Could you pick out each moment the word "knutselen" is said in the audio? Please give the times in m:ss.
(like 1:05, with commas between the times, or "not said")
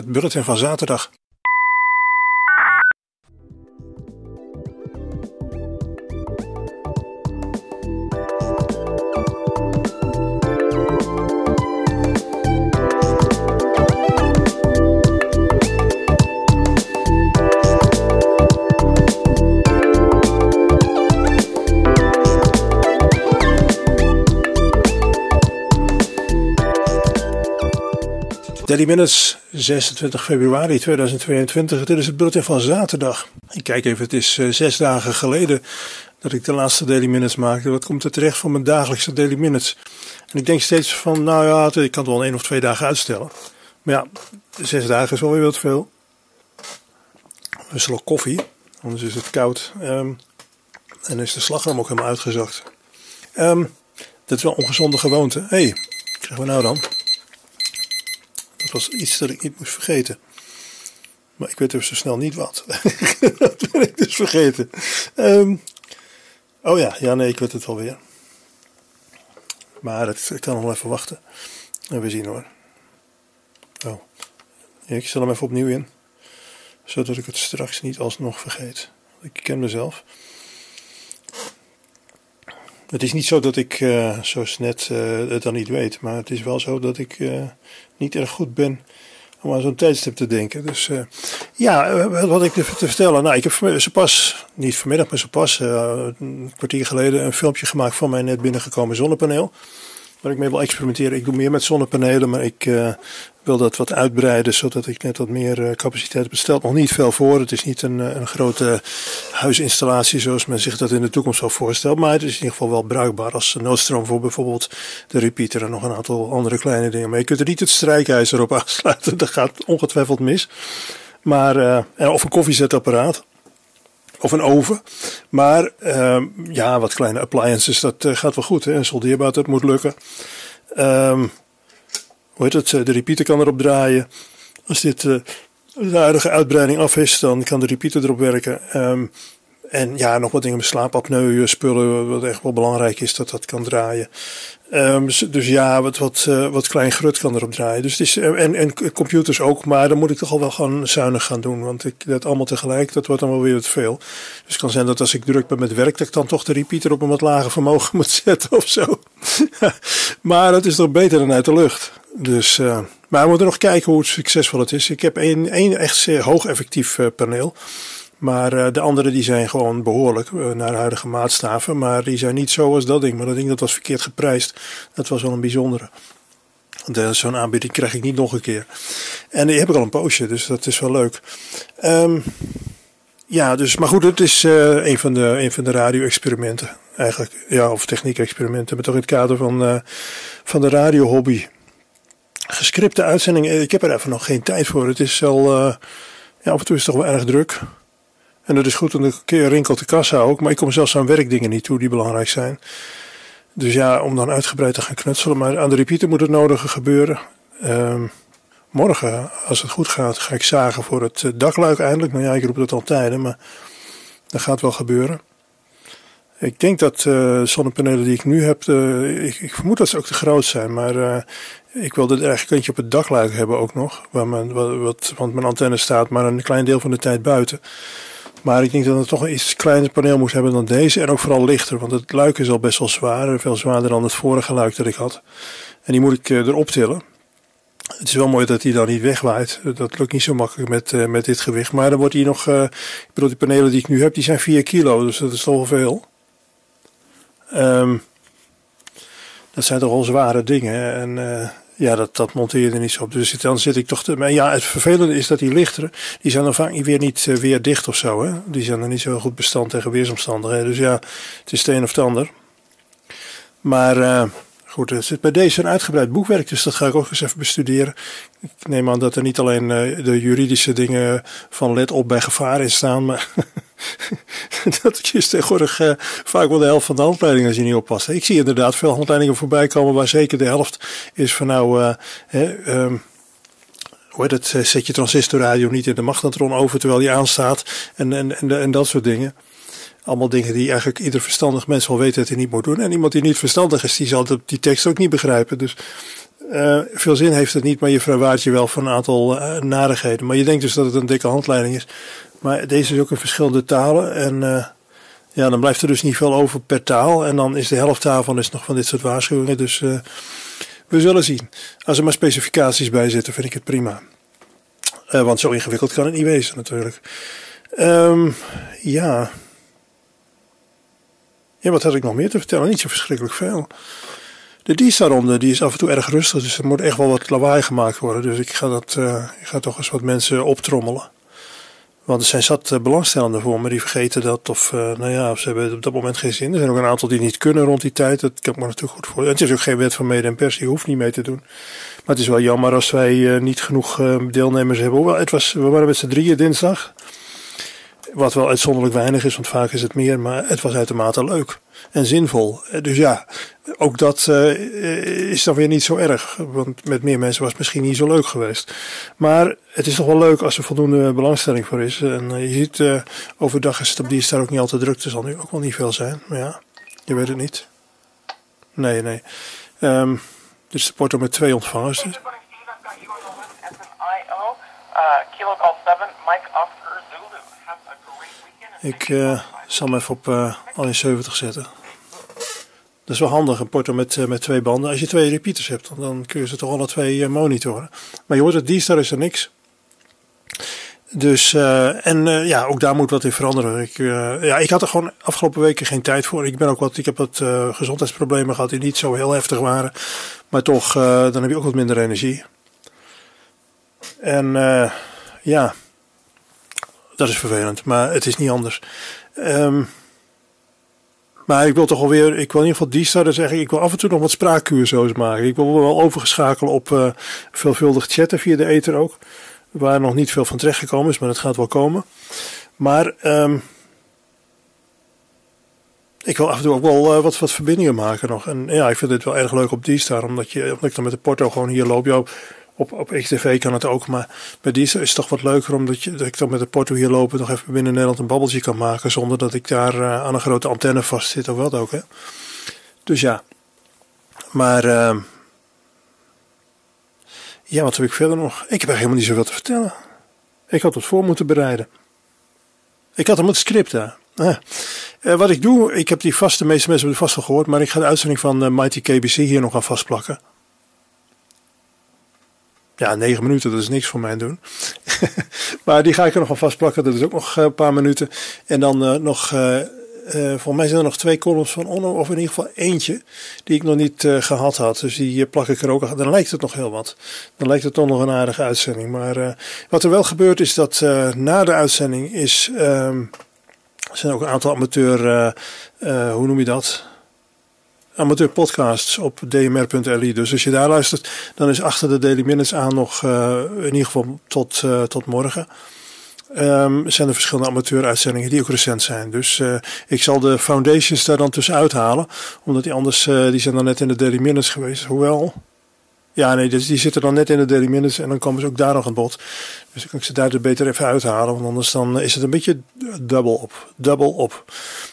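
3:24.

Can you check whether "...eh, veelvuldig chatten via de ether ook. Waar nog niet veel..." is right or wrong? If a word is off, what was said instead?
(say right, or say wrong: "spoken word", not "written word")
right.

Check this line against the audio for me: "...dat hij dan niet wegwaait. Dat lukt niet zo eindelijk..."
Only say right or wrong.
wrong.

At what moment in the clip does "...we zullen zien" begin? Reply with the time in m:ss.
5:10.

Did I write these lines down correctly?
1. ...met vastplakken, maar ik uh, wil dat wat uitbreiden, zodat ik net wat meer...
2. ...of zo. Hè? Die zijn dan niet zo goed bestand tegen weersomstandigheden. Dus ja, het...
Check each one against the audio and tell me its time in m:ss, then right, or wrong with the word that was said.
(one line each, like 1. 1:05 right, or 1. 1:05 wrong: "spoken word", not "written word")
1. 1:41 wrong: "zonnepanelen", not "vastplakken"
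2. 4:17 right.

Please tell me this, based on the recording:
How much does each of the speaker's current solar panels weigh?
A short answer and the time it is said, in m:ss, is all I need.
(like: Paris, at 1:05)
4 kilo, at 4:04.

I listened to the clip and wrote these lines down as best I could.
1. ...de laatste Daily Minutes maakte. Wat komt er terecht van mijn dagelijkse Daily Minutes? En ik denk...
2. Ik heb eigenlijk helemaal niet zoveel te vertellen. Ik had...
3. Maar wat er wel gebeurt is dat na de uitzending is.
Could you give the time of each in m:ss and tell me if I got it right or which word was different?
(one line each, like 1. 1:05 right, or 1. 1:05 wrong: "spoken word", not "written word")
1. 0:36 right
2. 7:28 right
3. 7:59 right.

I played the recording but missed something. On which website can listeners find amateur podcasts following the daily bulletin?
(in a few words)
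dmr.li.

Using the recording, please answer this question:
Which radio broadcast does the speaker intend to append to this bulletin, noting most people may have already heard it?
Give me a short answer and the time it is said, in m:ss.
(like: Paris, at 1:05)
Mighty KBC, at 7:38.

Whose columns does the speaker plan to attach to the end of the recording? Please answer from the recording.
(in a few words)
Onno.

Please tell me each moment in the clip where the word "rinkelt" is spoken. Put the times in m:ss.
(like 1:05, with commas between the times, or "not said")
3:19.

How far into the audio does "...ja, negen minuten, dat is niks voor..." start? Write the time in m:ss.
7:42.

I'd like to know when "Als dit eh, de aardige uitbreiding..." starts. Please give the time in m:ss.
2:14.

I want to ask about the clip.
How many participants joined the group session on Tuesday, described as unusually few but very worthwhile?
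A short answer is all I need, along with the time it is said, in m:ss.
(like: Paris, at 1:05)
3, at 5:46.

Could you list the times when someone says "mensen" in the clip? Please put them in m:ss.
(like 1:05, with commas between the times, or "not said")
5:30, 5:57, 7:36.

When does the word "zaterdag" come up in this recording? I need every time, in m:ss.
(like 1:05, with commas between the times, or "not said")
0:00, 0:32.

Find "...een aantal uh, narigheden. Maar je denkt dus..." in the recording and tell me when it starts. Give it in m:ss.
4:58.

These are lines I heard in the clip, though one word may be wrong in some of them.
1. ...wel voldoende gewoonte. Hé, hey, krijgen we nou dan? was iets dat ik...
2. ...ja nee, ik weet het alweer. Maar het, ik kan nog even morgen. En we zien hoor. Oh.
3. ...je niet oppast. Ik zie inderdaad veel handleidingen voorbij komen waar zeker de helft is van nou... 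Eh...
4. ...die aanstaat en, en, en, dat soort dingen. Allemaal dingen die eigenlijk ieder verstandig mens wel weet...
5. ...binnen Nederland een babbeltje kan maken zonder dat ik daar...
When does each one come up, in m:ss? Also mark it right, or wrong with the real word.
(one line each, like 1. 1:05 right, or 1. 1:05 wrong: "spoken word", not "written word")
1. 0:54 wrong: "ongezonde", not "voldoende"
2. 1:06 wrong: "wachten", not "morgen"
3. 4:37 right
4. 4:46 right
5. 7:17 right.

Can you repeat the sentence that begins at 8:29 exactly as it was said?
Dus ik kan ik ze daar beter even uithalen, want anders dan is het een beetje dubbel op.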